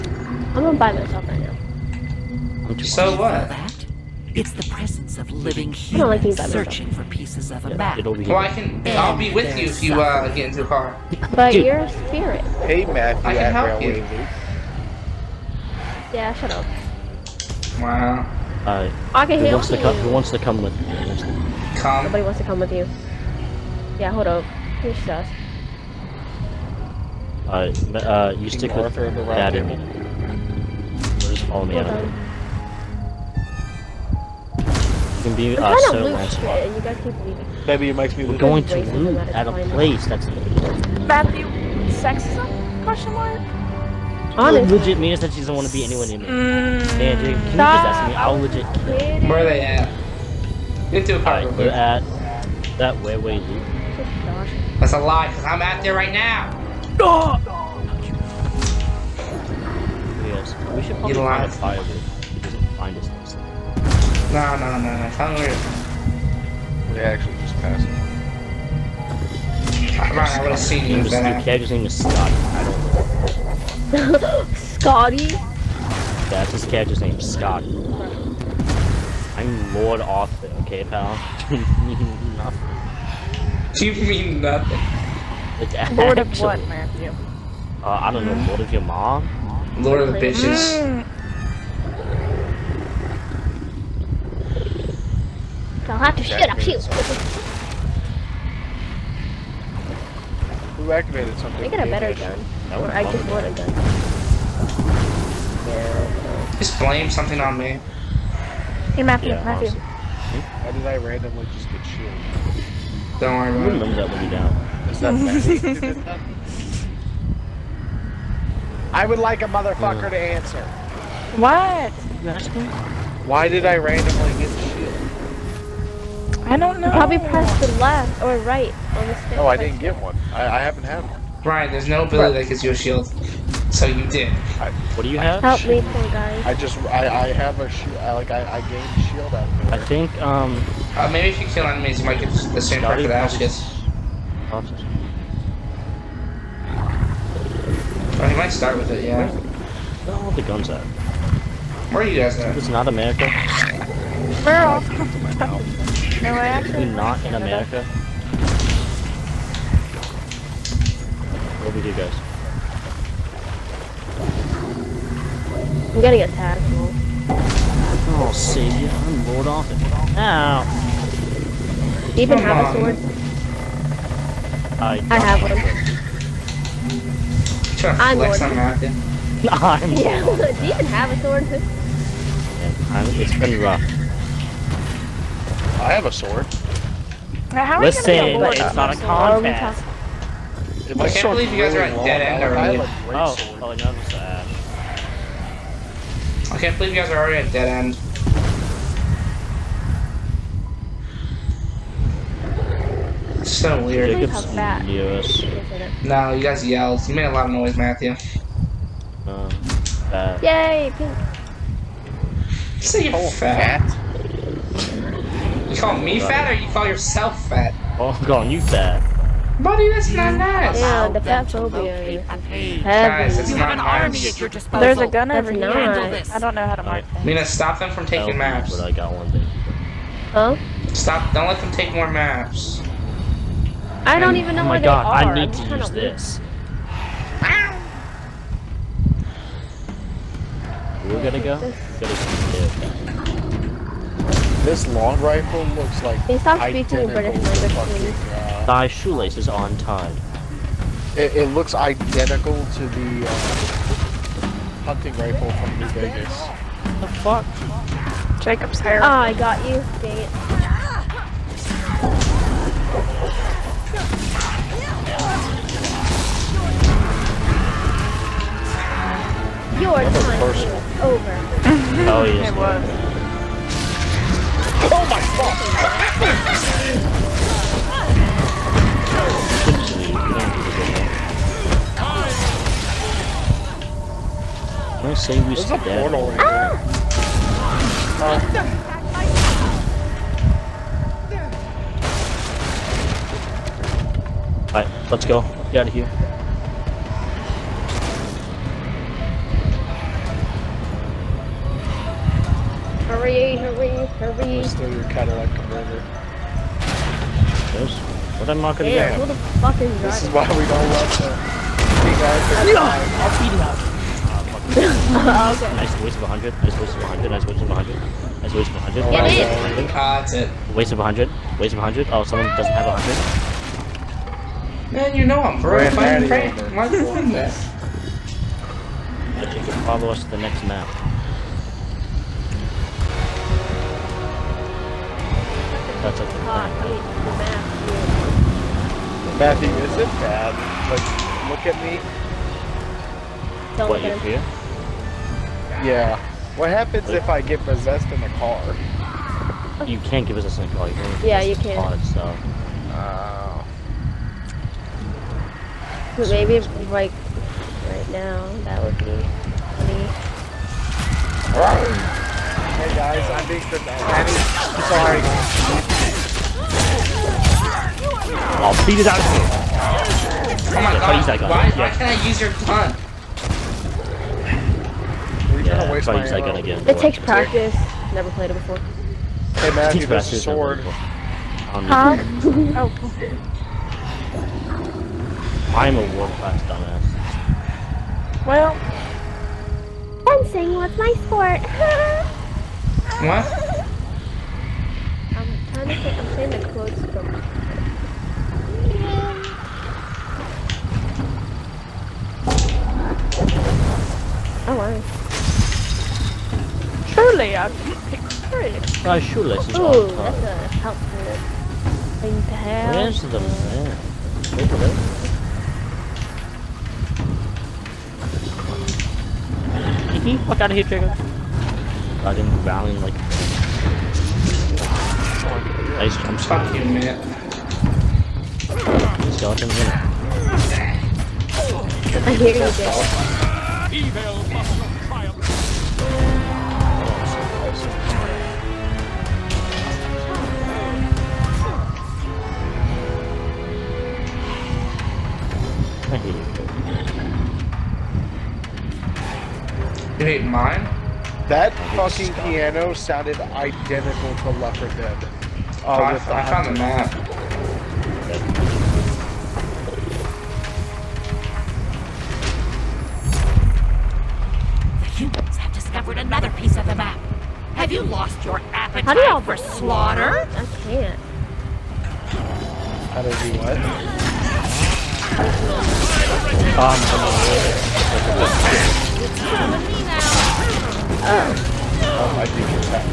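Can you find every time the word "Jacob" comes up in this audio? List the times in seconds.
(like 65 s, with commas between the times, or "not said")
204 s, 258 s.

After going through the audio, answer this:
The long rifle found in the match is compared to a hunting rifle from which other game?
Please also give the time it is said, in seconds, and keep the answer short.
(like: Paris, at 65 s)
New Vegas, at 255 s.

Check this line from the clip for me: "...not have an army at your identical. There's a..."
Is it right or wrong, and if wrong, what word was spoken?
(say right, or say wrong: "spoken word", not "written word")
wrong: "disposal", not "identical".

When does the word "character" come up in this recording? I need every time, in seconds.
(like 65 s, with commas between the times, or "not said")
71 s, 76 s.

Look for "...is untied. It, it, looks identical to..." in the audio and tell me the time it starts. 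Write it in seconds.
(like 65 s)
249 s.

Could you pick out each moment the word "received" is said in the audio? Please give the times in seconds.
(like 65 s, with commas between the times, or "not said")
not said.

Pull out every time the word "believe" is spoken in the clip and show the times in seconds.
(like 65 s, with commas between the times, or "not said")
191 s, 196 s.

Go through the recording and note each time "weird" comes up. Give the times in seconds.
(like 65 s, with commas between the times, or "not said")
203 s.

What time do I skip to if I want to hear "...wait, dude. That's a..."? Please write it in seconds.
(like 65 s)
53 s.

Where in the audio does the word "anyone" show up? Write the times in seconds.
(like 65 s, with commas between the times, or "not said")
45 s.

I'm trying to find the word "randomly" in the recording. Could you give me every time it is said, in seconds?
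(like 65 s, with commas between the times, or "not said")
110 s, 123 s.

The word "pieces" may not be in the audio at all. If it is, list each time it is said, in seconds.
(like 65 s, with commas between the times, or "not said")
7 s, 466 s.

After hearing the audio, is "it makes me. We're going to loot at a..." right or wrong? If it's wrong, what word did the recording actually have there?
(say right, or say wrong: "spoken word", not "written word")
right.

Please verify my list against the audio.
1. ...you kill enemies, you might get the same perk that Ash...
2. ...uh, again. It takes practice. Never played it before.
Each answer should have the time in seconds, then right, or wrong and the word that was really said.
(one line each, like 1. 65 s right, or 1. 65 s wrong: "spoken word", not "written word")
1. 141 s right
2. 376 s right.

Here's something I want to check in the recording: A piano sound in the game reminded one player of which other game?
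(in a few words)
Left 4 Dead.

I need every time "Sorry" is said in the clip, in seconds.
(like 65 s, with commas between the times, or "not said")
364 s.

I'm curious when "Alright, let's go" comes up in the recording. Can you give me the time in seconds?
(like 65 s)
294 s.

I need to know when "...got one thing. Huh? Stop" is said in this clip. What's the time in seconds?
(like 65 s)
228 s.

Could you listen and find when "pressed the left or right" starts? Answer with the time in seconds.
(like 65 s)
127 s.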